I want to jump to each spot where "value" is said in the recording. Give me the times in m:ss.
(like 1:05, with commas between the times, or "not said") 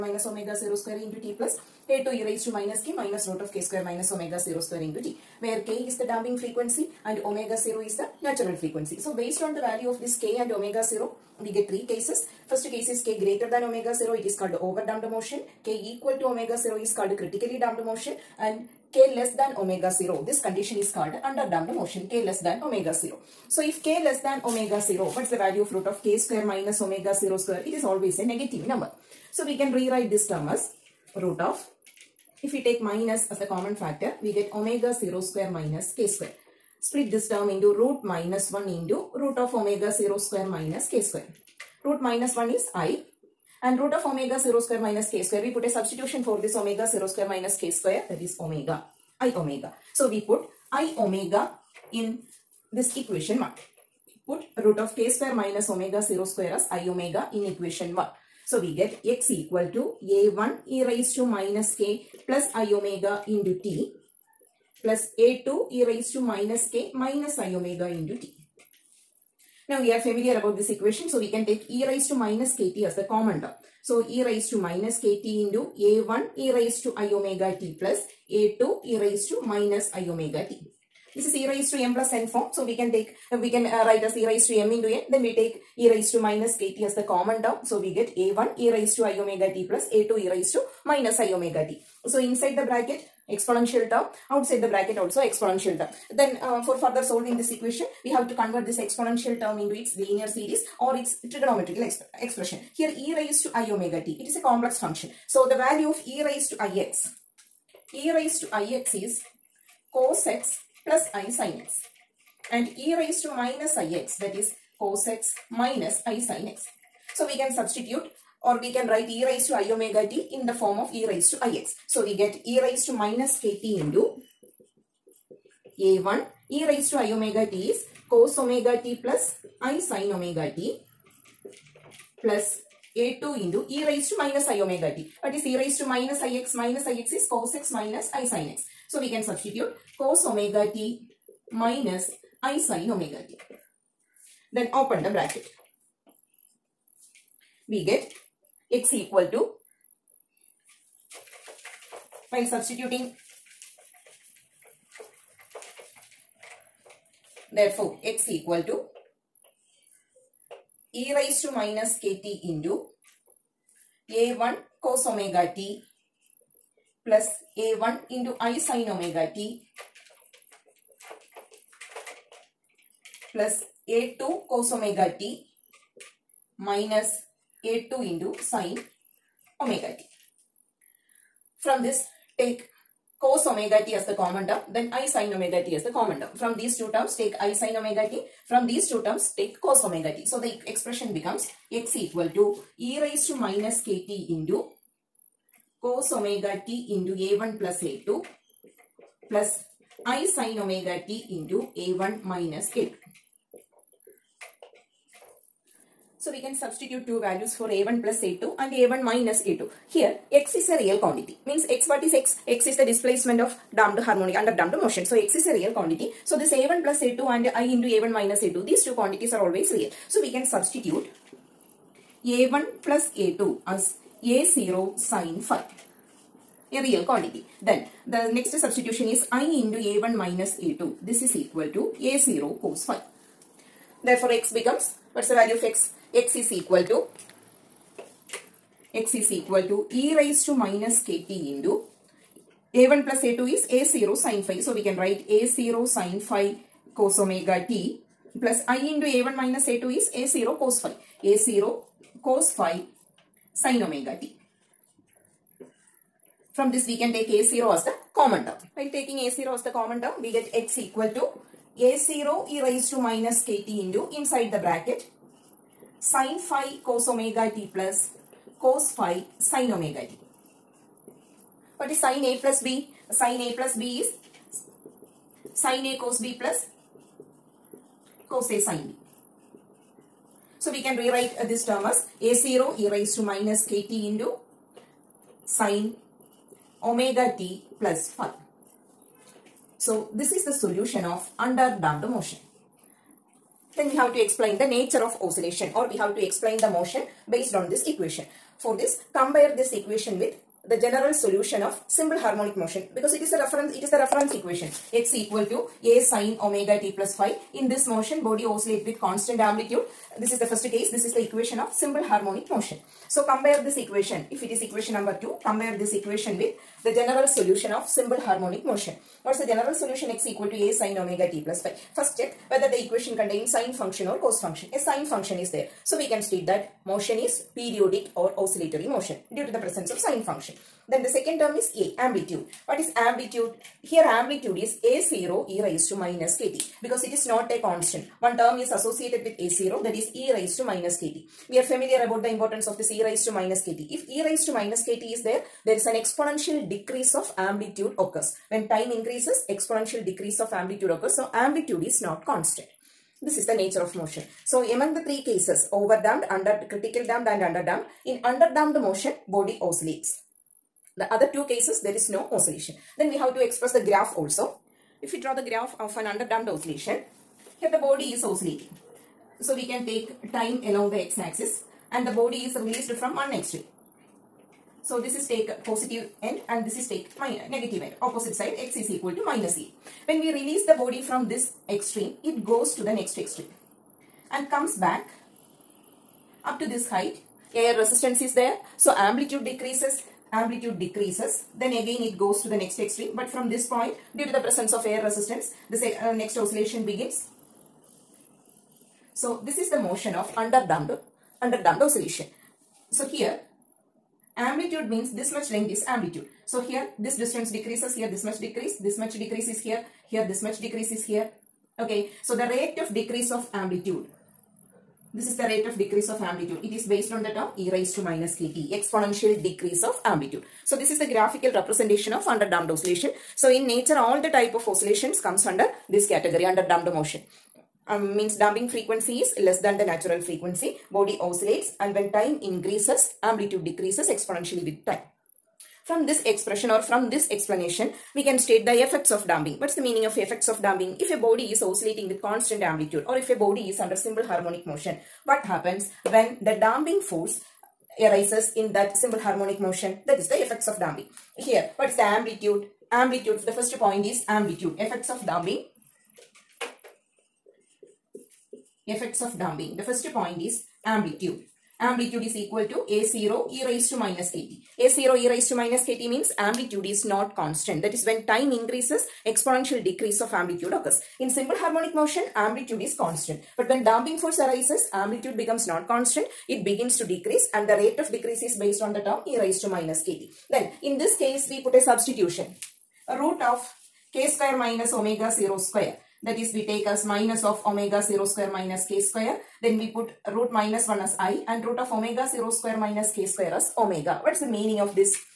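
0:09, 0:25, 1:45, 3:27, 3:55.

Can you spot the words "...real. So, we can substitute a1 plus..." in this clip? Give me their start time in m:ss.
3:39.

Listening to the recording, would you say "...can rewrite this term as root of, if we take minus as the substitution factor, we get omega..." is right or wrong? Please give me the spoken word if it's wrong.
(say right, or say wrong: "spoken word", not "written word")
wrong: "common", not "substitution".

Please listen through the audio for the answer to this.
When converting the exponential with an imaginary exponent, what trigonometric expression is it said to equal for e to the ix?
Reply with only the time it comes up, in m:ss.
1:49.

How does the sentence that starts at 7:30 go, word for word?
That is the effects of damping.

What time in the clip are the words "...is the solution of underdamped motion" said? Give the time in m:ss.
4:50.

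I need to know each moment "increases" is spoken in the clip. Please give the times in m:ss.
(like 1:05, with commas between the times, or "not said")
5:48, 7:12, 7:48.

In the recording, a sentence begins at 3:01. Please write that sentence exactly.
From this take cos omega t as the common term then i sine omega t as the common term.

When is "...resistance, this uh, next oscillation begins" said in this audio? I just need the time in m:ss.
6:35.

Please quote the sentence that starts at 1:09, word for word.
Now we are familiar about this equation so we can take e raised to minus kt as the common term.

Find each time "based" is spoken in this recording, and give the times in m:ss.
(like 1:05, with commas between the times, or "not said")
0:09, 4:57, 6:56, 7:58.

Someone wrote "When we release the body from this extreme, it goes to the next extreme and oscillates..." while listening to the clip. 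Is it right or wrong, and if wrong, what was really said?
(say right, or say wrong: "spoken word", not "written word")
wrong: "comes", not "oscillates".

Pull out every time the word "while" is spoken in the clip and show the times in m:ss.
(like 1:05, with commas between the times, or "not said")
2:32, 4:18.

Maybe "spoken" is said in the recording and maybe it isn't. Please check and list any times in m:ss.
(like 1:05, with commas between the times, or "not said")
not said.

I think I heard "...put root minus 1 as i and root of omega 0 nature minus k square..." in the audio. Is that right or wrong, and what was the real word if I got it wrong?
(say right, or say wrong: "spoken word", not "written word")
wrong: "square", not "nature".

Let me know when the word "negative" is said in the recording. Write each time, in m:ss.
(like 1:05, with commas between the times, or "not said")
0:28, 6:17.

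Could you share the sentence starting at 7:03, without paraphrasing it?
So in nature all the type of oscillations comes under this category underdamped motion.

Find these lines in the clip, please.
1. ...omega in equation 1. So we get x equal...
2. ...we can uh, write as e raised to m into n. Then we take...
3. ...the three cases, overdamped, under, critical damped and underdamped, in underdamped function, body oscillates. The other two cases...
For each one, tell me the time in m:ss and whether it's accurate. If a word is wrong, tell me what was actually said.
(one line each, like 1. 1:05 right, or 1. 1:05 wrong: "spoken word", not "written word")
1. 0:56 right
2. 1:23 right
3. 5:54 wrong: "motion", not "function".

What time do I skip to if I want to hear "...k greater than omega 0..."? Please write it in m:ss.
0:13.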